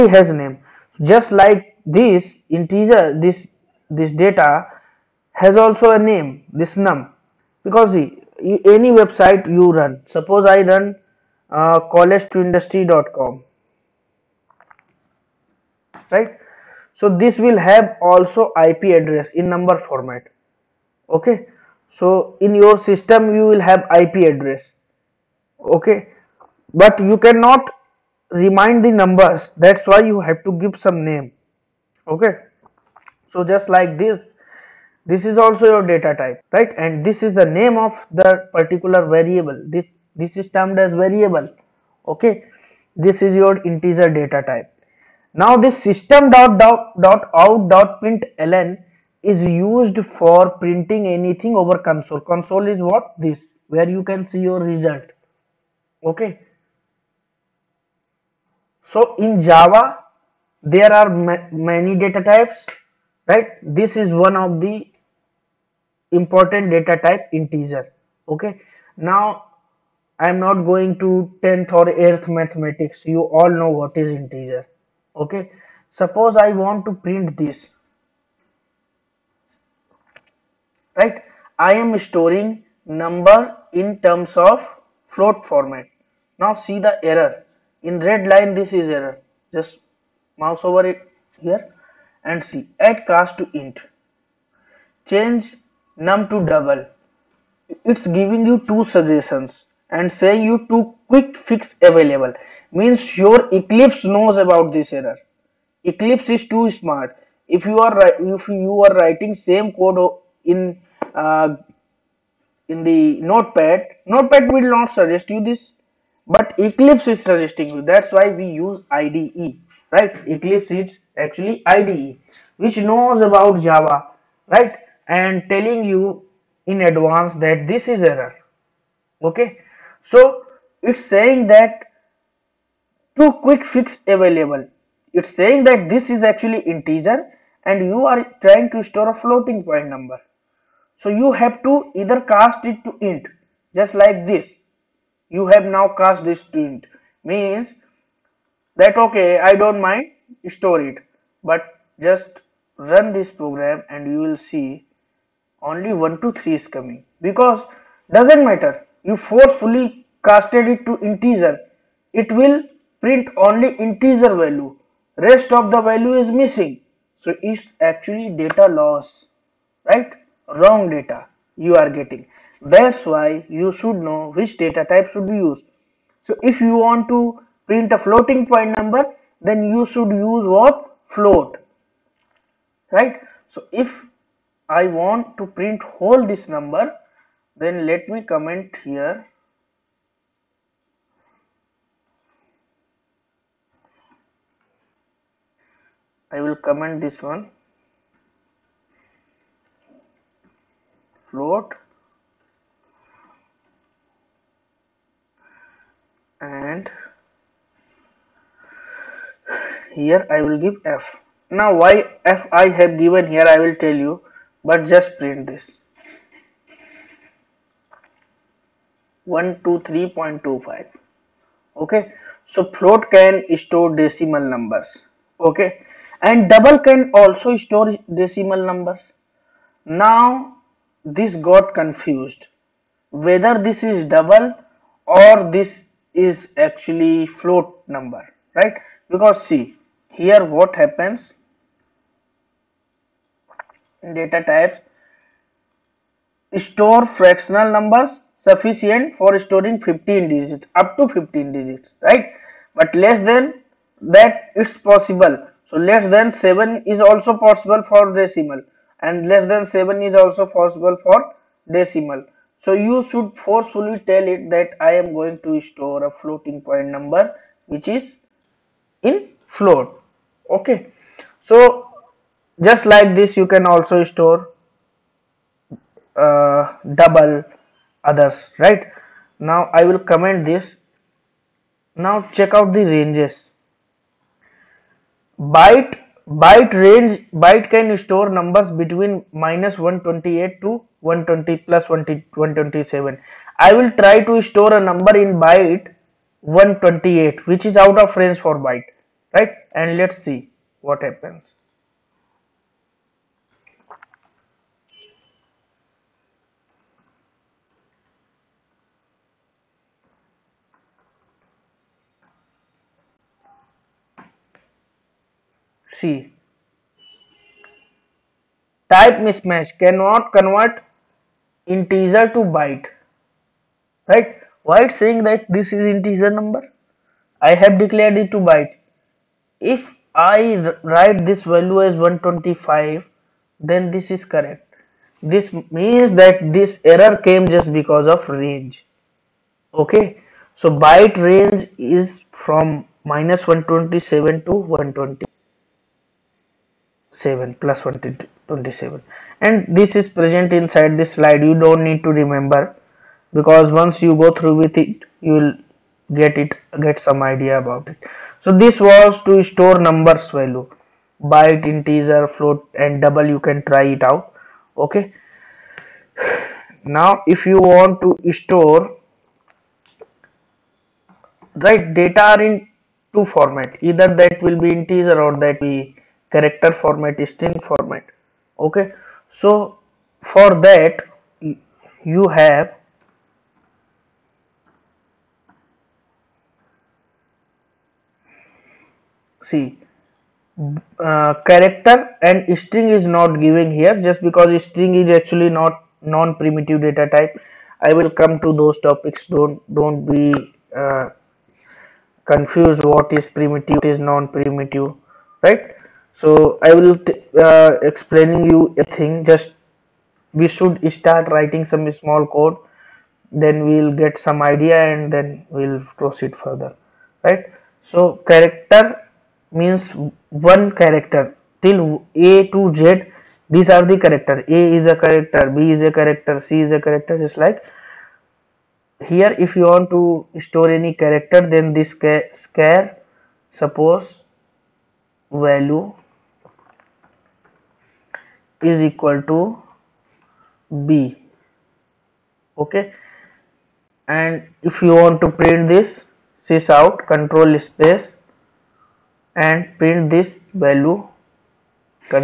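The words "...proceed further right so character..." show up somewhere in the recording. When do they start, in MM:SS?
06:55.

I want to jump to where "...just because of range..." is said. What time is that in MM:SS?
05:37.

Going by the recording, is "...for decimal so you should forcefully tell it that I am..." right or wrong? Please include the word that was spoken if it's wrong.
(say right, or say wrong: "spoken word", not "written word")
right.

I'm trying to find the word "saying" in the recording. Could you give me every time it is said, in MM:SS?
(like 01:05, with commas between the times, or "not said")
01:40, 02:11, 02:15, 05:25.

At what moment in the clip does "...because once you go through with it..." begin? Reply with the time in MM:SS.
05:53.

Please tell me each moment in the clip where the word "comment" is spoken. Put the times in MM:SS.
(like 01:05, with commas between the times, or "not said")
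03:08, 03:16, 04:39.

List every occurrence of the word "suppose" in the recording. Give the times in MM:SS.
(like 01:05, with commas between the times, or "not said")
00:10, 01:15, 07:13.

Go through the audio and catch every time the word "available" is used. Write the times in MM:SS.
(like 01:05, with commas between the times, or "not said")
01:41, 02:14.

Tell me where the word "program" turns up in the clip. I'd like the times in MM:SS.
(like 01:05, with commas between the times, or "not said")
02:33.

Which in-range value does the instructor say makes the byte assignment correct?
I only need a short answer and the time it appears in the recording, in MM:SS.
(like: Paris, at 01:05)
125, at 05:31.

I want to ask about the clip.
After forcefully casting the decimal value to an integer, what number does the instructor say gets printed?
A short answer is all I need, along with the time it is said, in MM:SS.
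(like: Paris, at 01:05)
123, at 02:35.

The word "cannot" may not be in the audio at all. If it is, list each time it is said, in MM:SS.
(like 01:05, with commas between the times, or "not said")
00:27, 05:19.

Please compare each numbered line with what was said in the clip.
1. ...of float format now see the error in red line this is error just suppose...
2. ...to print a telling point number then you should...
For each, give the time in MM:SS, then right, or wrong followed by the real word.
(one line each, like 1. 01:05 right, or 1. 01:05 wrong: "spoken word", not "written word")
1. 01:24 wrong: "mouse", not "suppose"
2. 02:57 wrong: "floating", not "telling".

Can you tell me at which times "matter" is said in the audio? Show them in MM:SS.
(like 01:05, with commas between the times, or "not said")
02:38.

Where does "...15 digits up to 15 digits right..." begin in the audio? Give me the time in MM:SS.
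04:09.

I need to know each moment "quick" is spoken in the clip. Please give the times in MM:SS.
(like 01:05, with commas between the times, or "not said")
01:41, 02:13.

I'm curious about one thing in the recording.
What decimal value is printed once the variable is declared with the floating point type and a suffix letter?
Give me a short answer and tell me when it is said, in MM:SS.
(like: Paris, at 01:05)
123.25, at 03:39.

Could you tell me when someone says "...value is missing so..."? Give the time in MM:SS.
02:45.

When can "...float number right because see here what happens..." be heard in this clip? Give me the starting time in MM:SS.
03:57.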